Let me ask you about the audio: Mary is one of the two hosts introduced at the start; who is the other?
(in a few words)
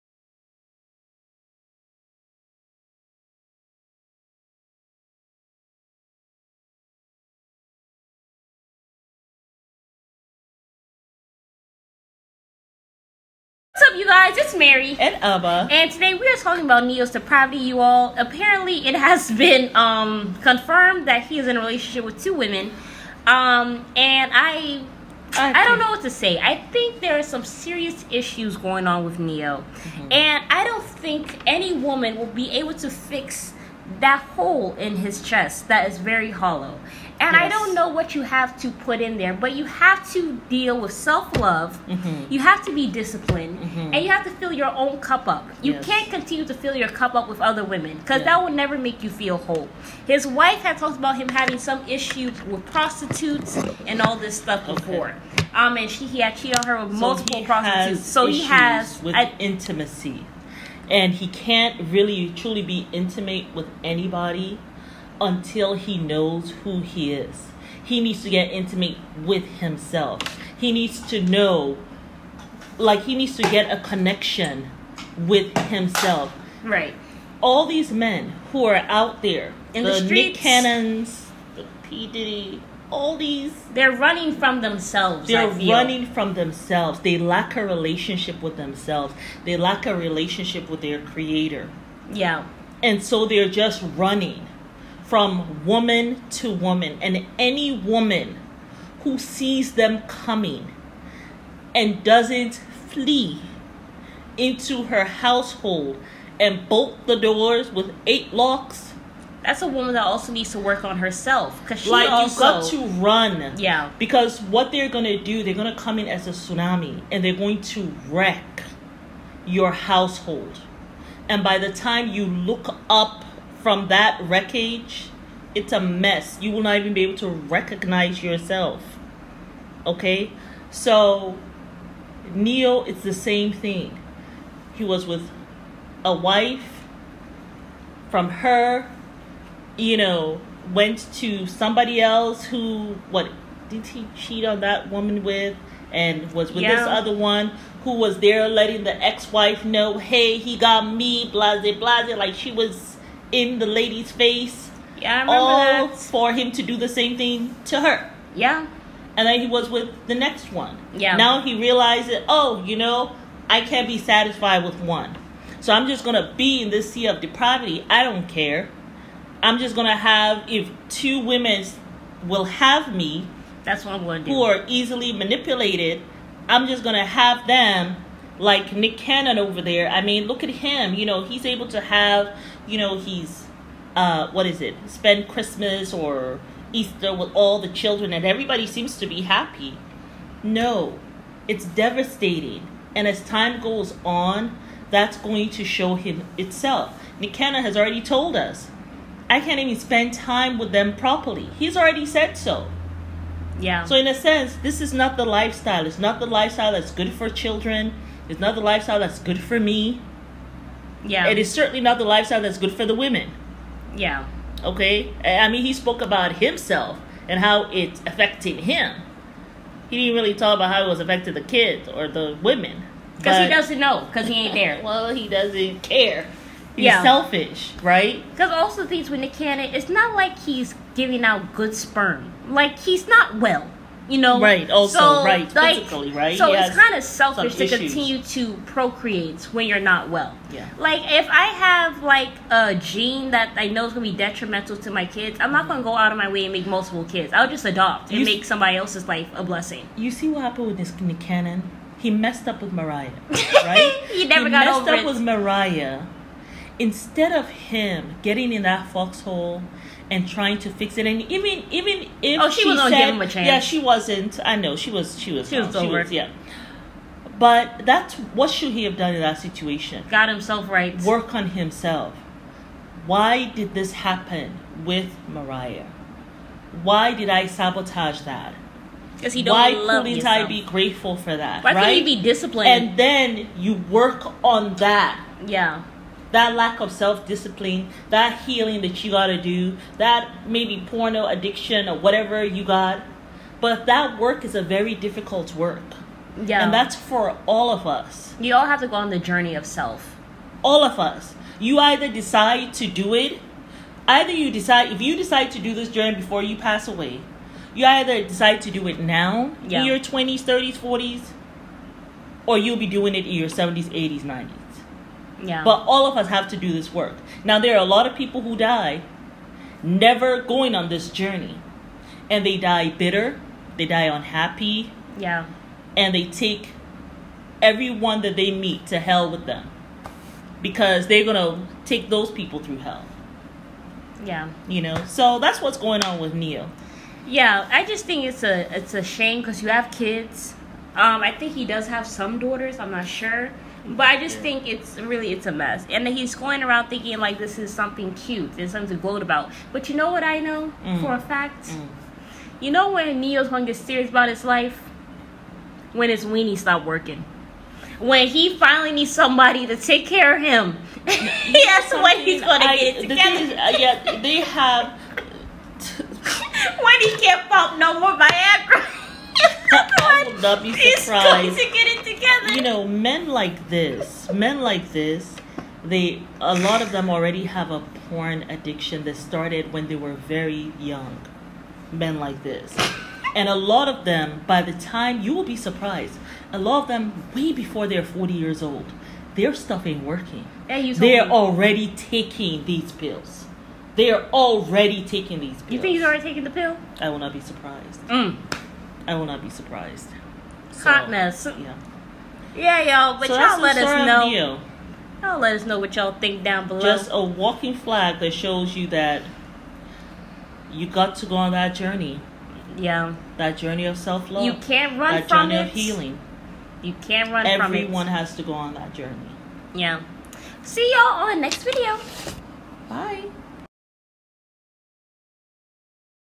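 Ama.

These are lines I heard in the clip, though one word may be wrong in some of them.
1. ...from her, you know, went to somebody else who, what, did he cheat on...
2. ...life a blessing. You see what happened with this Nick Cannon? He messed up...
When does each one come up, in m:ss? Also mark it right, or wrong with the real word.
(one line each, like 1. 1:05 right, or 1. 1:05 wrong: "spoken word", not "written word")
1. 2:18 right
2. 4:09 right.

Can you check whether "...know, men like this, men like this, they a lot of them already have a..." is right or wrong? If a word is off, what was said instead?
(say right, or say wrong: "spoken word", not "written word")
right.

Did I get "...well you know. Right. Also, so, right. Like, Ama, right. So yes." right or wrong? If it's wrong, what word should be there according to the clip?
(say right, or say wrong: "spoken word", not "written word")
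wrong: "Physically", not "Ama".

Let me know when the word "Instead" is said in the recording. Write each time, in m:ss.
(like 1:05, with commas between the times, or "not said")
4:16.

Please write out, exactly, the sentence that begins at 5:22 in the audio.
And they die bitter, they die unhappy.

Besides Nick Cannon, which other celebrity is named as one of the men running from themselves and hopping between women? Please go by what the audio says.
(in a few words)
P Diddy.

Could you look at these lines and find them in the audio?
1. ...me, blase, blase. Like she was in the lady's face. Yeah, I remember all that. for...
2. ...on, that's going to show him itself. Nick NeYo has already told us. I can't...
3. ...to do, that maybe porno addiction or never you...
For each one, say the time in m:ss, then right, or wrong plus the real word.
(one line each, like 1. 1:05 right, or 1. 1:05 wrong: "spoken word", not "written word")
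1. 2:30 right
2. 3:14 wrong: "Cannon", not "NeYo"
3. 4:49 wrong: "whatever", not "never".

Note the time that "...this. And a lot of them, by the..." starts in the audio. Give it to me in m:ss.
6:22.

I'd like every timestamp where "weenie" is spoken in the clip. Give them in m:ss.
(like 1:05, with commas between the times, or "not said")
5:56.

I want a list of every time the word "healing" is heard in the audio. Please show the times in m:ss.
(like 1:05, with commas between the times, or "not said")
4:48, 6:55.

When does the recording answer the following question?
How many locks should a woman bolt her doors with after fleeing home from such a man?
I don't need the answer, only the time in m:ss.
1:48.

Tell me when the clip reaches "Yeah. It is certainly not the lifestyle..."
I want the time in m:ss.
3:31.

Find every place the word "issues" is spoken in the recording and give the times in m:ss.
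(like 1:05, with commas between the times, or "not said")
0:28, 0:51.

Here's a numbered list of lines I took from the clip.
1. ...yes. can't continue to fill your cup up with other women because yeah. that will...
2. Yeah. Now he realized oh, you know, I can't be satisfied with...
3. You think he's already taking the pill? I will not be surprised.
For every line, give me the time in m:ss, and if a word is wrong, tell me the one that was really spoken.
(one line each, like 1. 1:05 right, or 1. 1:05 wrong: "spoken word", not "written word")
1. 0:45 right
2. 2:40 right
3. 6:35 right.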